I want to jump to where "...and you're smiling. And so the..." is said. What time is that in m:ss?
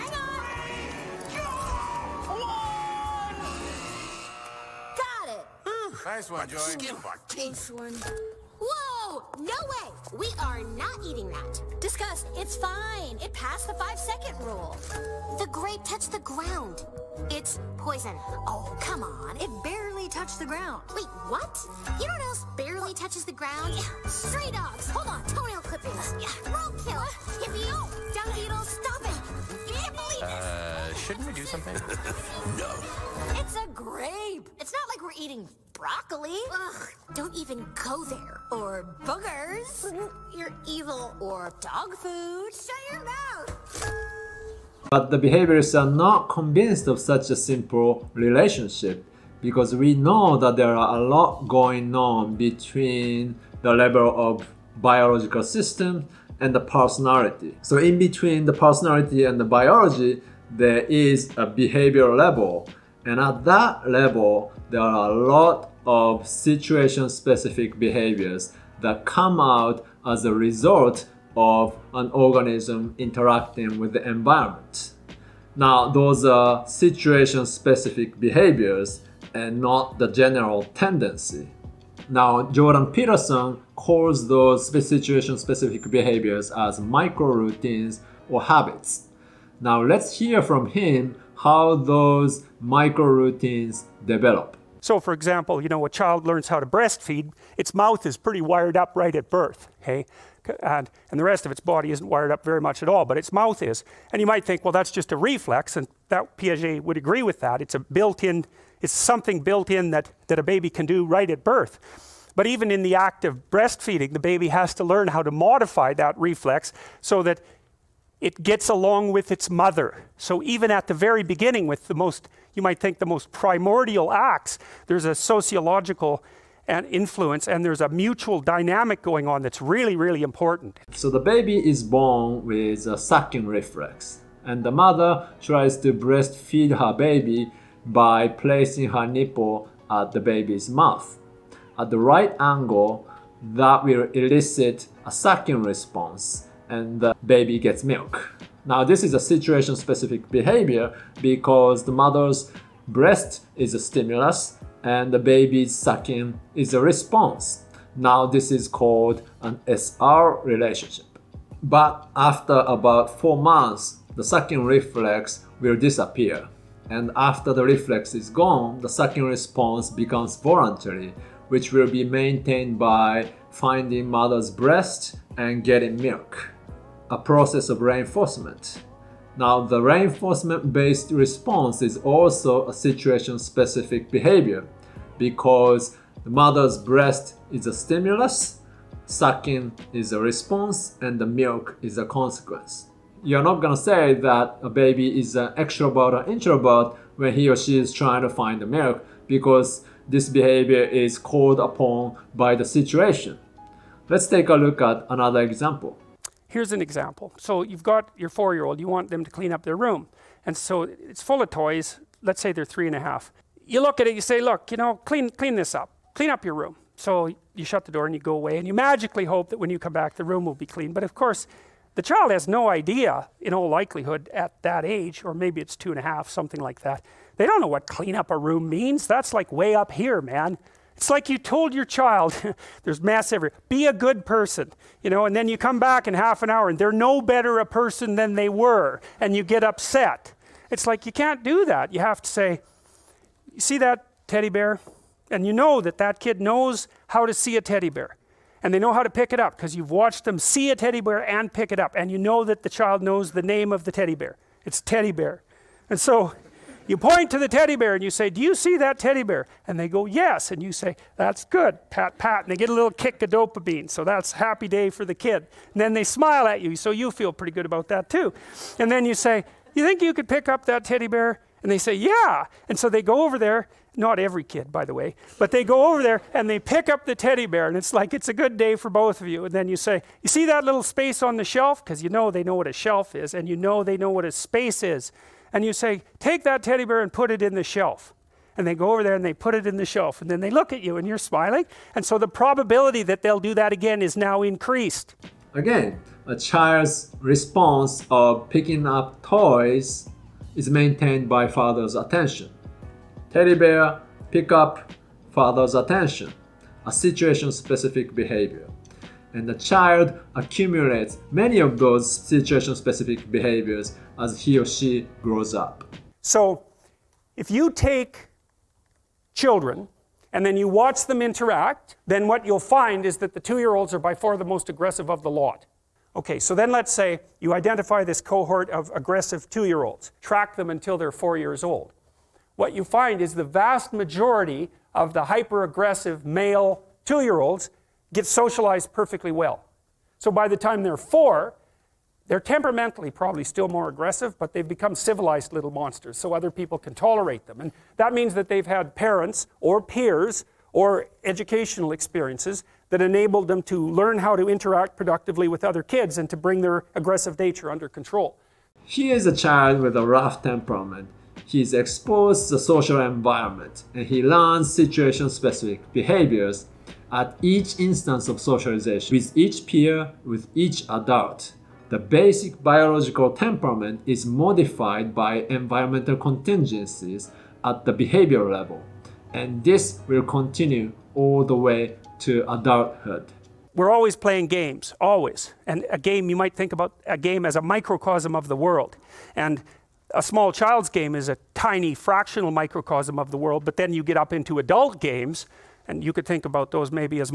4:50.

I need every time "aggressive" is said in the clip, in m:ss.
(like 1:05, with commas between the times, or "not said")
5:24, 5:28, 5:35, 5:43, 5:56.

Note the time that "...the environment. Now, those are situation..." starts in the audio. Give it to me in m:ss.
1:13.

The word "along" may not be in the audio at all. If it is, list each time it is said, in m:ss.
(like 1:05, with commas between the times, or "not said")
1:58.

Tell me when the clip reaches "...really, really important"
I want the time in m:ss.
2:09.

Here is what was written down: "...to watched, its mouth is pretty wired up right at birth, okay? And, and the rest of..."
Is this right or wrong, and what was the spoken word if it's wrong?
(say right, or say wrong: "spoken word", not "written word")
wrong: "breastfeed", not "watched".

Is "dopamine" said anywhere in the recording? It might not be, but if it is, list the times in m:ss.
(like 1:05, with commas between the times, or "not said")
4:23.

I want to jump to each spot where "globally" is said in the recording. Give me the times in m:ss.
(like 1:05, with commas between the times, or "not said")
not said.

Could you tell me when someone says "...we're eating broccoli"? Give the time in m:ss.
0:35.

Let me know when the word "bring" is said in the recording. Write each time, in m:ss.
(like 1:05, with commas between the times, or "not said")
5:56.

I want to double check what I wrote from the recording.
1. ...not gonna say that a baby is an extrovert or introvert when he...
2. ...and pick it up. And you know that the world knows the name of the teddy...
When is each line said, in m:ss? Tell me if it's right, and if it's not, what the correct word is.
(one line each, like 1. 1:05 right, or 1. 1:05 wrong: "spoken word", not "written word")
1. 3:13 right
2. 4:11 wrong: "child", not "world".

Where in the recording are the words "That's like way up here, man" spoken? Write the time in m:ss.
3:49.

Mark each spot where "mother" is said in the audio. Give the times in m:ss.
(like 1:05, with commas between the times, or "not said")
1:59, 2:14, 2:31, 2:54, 3:06.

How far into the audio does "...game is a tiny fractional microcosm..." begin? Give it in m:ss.
6:30.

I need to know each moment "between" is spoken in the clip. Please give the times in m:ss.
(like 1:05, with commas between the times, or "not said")
0:52, 0:57.